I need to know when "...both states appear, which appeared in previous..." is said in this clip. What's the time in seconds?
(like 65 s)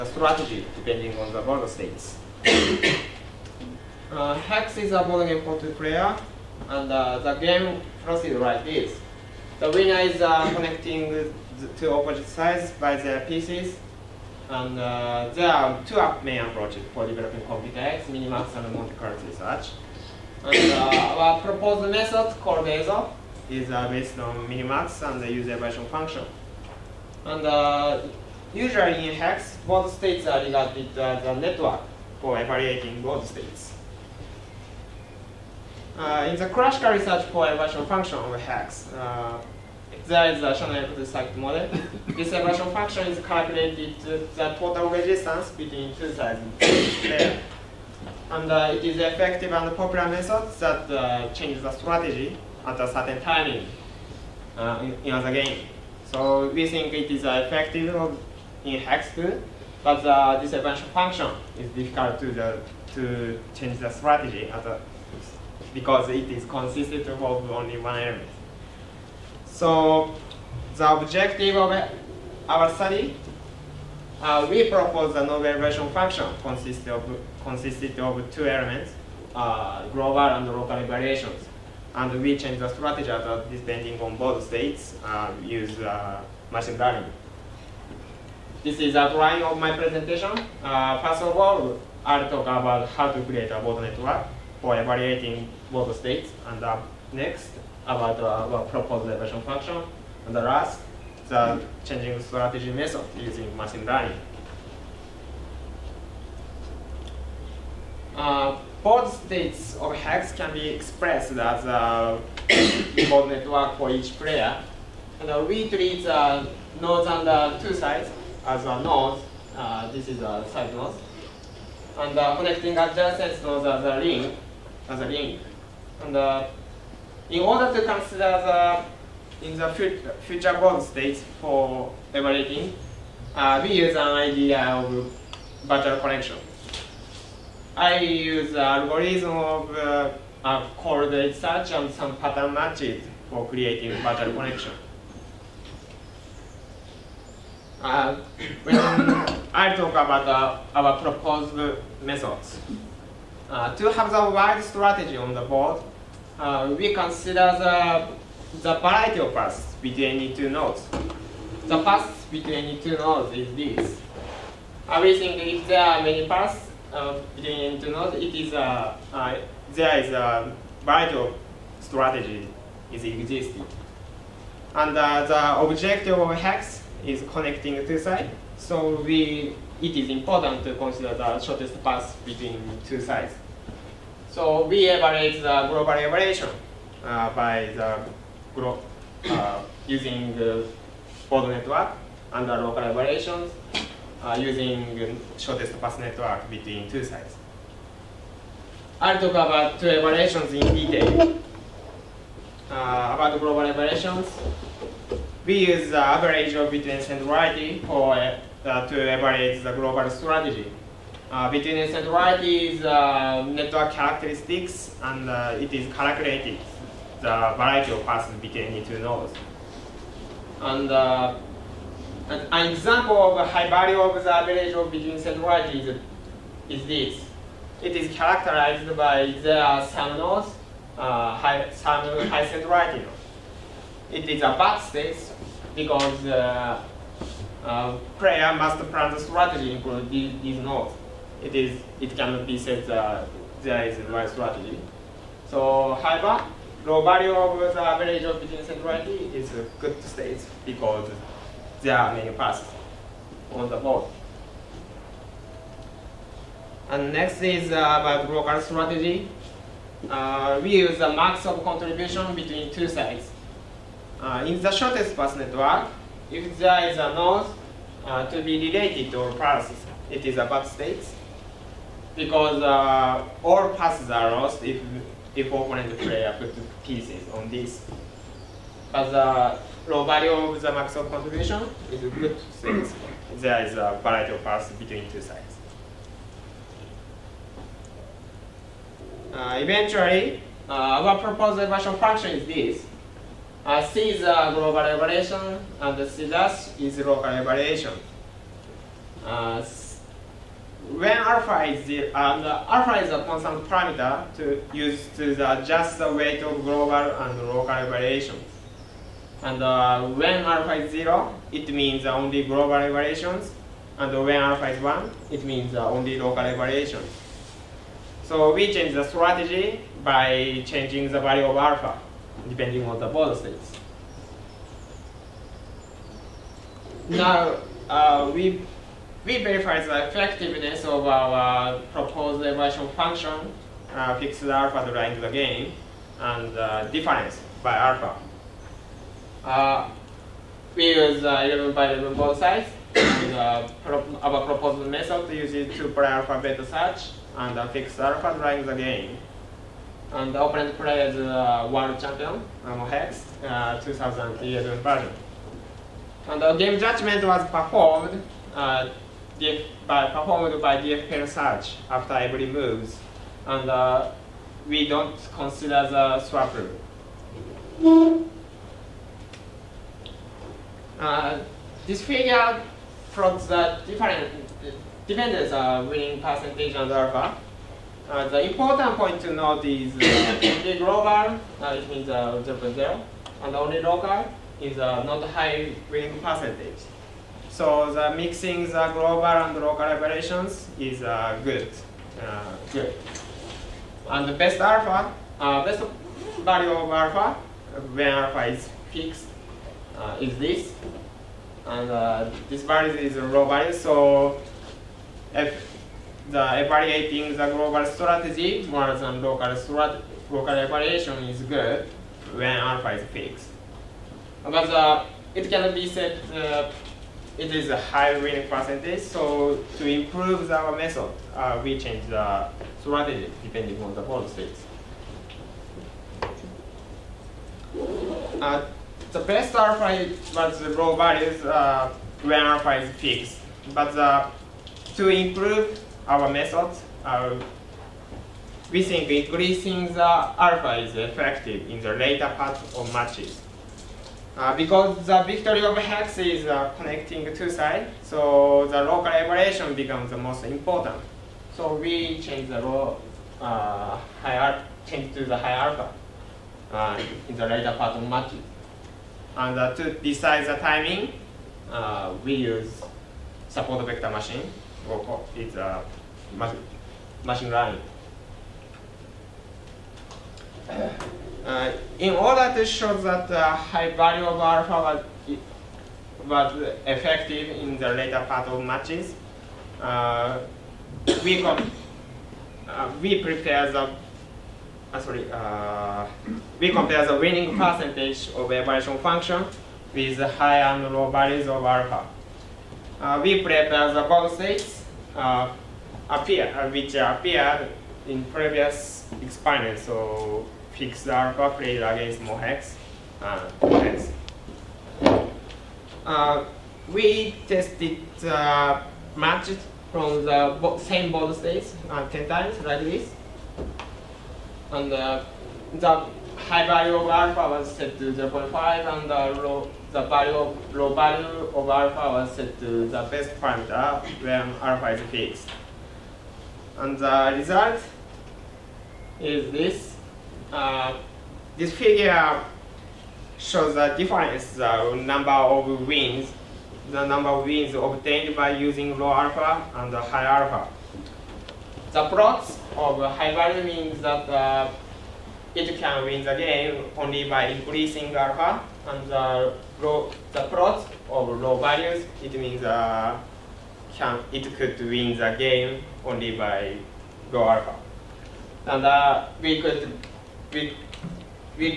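494 s.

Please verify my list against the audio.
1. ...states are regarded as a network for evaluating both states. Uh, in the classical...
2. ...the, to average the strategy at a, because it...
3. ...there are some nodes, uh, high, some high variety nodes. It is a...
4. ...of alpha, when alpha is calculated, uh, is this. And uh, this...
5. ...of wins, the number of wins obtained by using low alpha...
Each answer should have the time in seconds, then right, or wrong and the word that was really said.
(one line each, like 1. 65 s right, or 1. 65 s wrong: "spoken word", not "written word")
1. 29 s right
2. 62 s wrong: "change", not "average"
3. 229 s wrong: "singularity", not "variety"
4. 396 s wrong: "fixed", not "calculated"
5. 535 s right.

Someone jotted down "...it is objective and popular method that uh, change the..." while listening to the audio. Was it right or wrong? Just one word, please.
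wrong.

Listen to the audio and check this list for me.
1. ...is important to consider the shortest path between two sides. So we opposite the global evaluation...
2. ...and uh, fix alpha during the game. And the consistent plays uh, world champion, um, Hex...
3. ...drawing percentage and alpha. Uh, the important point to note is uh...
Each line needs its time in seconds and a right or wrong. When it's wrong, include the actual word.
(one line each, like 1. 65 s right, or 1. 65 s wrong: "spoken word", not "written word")
1. 179 s wrong: "evaluate", not "opposite"
2. 347 s wrong: "opponent", not "consistent"
3. 375 s wrong: "winning", not "drawing".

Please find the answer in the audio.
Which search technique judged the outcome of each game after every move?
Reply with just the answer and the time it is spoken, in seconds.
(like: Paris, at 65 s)
DFPN search, at 360 s.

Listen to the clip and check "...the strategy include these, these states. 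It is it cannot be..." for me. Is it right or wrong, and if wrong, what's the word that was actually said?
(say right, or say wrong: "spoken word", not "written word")
wrong: "nodes", not "states".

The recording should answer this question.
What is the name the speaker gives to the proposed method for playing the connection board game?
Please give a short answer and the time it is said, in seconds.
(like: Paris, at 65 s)
ESO, at 22 s.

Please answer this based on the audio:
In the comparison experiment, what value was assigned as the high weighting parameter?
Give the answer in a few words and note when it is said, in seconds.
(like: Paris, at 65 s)
0.5, at 518 s.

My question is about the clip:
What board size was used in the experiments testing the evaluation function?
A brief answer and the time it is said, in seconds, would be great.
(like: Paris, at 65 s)
11 by 11, at 341 s.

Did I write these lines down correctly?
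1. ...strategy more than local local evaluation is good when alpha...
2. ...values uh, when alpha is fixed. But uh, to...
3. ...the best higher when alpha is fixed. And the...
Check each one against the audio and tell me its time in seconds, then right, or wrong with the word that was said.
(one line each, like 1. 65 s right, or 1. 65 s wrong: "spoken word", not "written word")
1. 407 s right
2. 430 s right
3. 522 s wrong: "parameter", not "higher".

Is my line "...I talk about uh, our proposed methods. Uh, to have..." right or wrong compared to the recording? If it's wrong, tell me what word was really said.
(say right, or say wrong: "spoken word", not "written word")
right.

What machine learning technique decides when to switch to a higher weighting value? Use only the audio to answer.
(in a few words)
Support vector machine.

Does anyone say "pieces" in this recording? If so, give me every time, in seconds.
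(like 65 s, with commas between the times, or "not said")
13 s, 276 s.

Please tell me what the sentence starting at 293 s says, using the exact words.
Uh, C is a global evaluation, and C dash is local evaluation.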